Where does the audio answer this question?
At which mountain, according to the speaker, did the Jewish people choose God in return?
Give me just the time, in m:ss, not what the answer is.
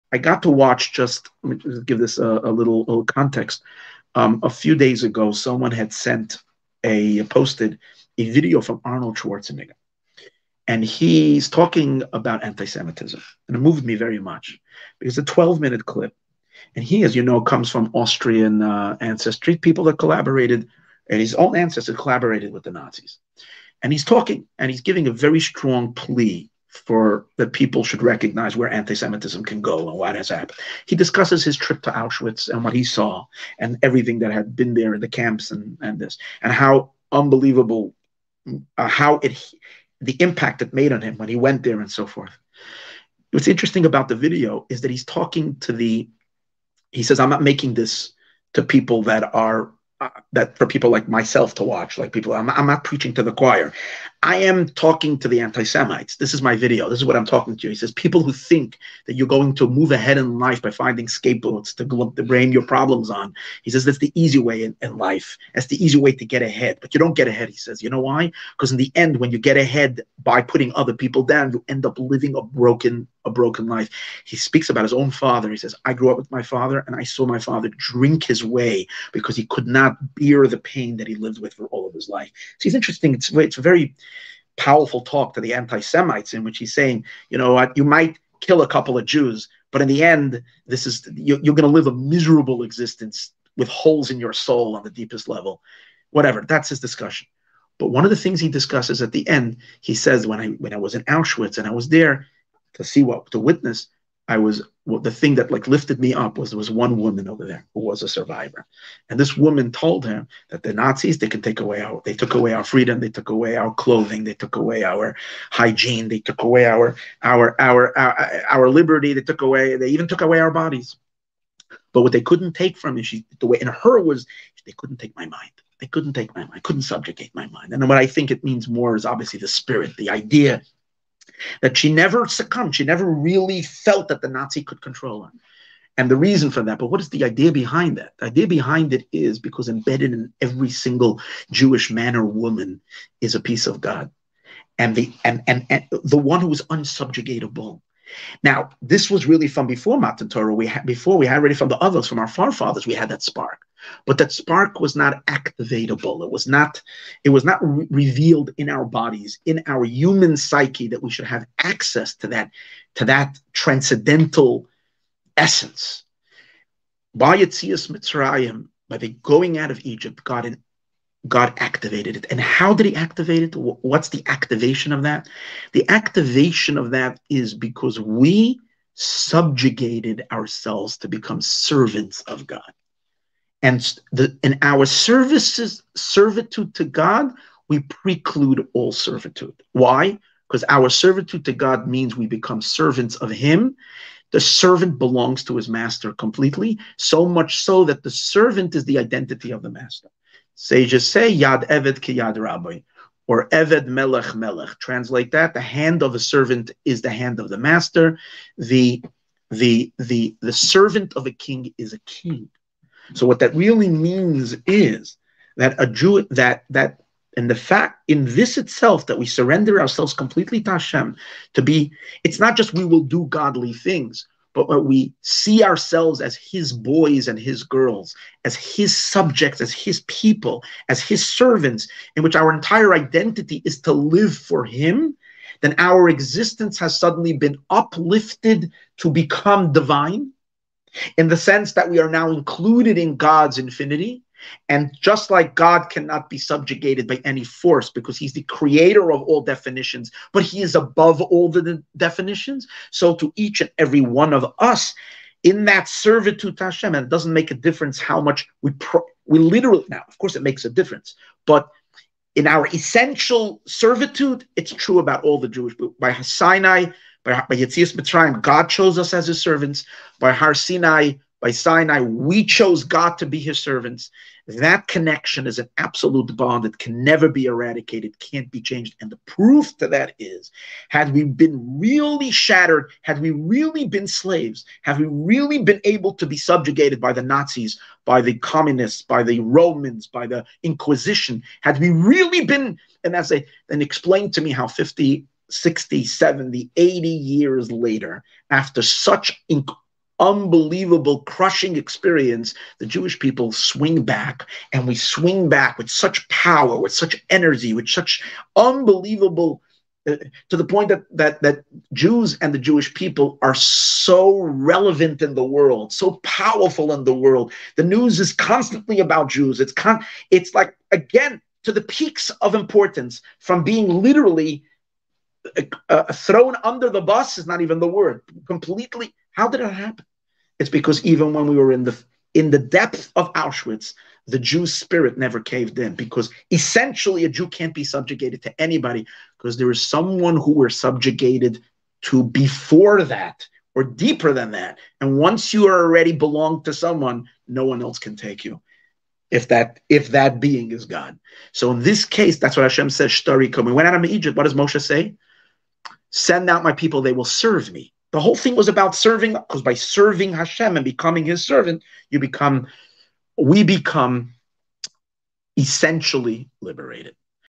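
4:30.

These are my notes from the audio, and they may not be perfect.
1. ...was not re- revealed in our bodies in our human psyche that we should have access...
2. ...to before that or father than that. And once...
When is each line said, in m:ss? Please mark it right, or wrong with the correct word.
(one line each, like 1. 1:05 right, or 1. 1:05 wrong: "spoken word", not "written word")
1. 2:37 right
2. 5:42 wrong: "deeper", not "father".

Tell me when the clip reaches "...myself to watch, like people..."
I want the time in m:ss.
0:51.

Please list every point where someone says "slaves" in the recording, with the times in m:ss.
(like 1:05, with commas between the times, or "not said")
4:44.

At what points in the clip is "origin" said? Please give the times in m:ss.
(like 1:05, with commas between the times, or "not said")
not said.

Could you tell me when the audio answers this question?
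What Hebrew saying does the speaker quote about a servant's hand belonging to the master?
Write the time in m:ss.
3:21.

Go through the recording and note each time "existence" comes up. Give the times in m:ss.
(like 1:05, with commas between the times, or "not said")
1:32, 3:56.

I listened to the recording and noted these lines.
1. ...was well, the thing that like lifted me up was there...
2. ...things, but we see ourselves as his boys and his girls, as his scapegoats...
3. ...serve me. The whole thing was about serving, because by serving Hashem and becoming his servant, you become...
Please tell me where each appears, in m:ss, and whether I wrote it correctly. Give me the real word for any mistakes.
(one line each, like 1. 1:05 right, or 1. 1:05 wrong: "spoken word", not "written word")
1. 1:44 right
2. 3:43 wrong: "subjects", not "scapegoats"
3. 5:57 right.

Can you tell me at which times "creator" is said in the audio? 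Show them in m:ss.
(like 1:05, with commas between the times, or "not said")
4:08.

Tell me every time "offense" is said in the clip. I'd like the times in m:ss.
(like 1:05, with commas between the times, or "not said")
not said.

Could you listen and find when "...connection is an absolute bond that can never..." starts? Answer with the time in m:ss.
4:34.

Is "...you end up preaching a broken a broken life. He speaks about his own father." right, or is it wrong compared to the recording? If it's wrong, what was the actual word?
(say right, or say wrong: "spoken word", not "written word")
wrong: "living", not "preaching".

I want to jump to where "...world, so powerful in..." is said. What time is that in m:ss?
5:15.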